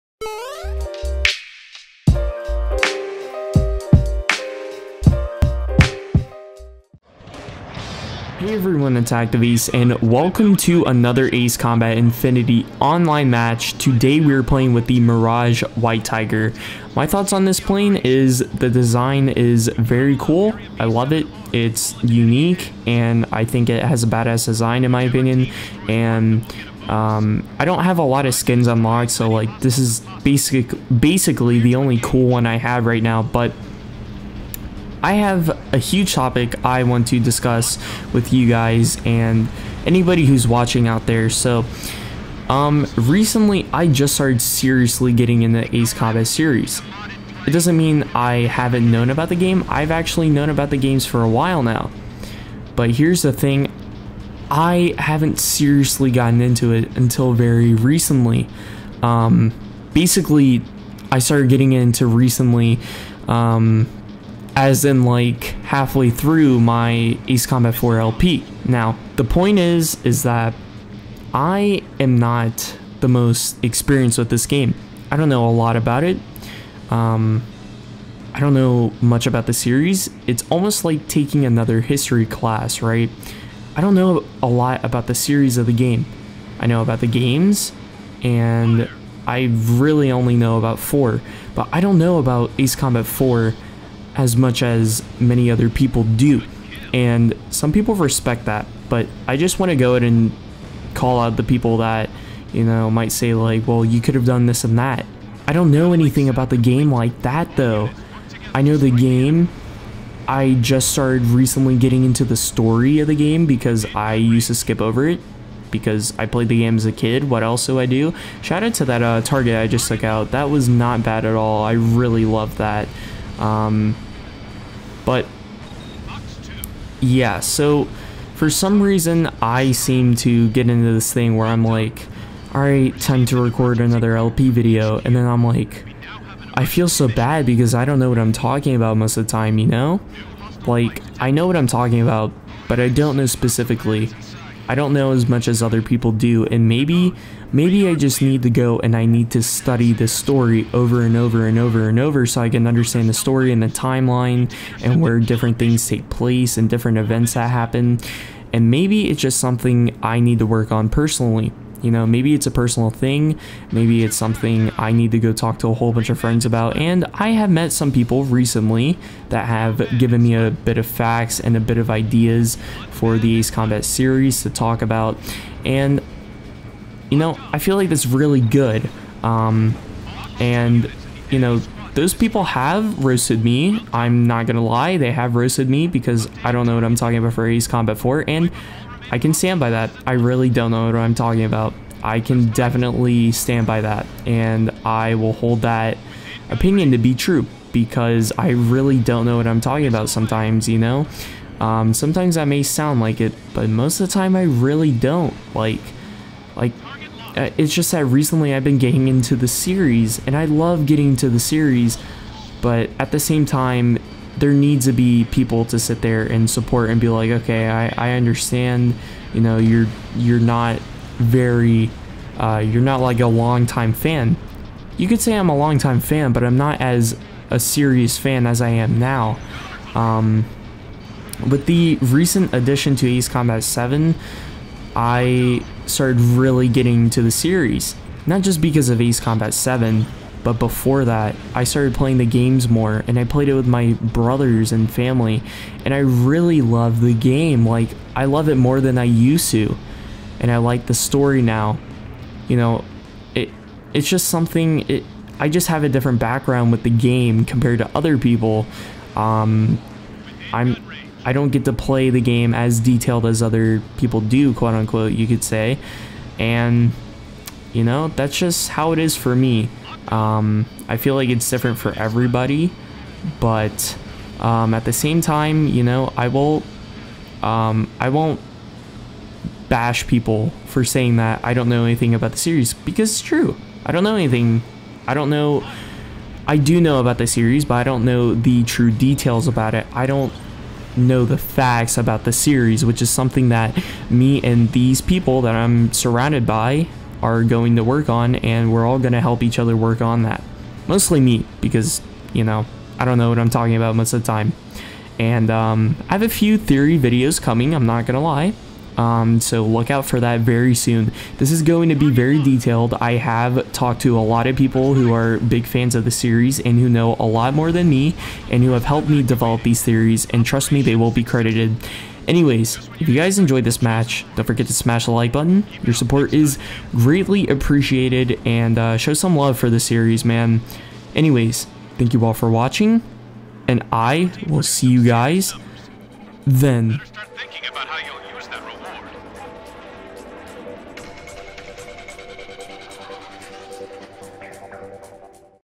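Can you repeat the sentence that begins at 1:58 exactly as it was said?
Shout out to that uh, target I just took out.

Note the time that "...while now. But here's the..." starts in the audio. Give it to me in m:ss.
0:51.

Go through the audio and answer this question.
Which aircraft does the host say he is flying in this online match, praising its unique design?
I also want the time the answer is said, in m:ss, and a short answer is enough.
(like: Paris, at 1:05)
Mirage White Tiger, at 0:14.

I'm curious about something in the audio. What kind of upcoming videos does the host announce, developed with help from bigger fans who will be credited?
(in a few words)
theory videos.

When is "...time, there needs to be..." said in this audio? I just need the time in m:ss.
3:33.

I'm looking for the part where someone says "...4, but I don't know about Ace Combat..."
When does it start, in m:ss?
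1:30.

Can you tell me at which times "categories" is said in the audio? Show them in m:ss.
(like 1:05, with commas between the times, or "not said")
not said.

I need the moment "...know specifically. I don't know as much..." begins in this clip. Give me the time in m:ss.
2:23.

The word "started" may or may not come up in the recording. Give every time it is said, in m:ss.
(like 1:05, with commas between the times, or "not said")
0:44, 1:01, 1:50, 3:55, 4:01.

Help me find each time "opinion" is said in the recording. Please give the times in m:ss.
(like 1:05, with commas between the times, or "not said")
0:25, 3:16.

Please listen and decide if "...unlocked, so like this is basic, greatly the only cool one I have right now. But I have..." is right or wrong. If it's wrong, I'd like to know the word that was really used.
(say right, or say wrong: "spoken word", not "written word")
wrong: "basically", not "greatly".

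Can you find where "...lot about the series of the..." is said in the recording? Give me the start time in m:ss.
1:24.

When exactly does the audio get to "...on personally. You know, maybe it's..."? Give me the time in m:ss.
2:40.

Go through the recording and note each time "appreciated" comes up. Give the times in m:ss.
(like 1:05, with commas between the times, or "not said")
5:27.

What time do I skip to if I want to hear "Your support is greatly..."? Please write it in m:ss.
5:25.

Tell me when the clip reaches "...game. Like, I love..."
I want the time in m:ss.
4:07.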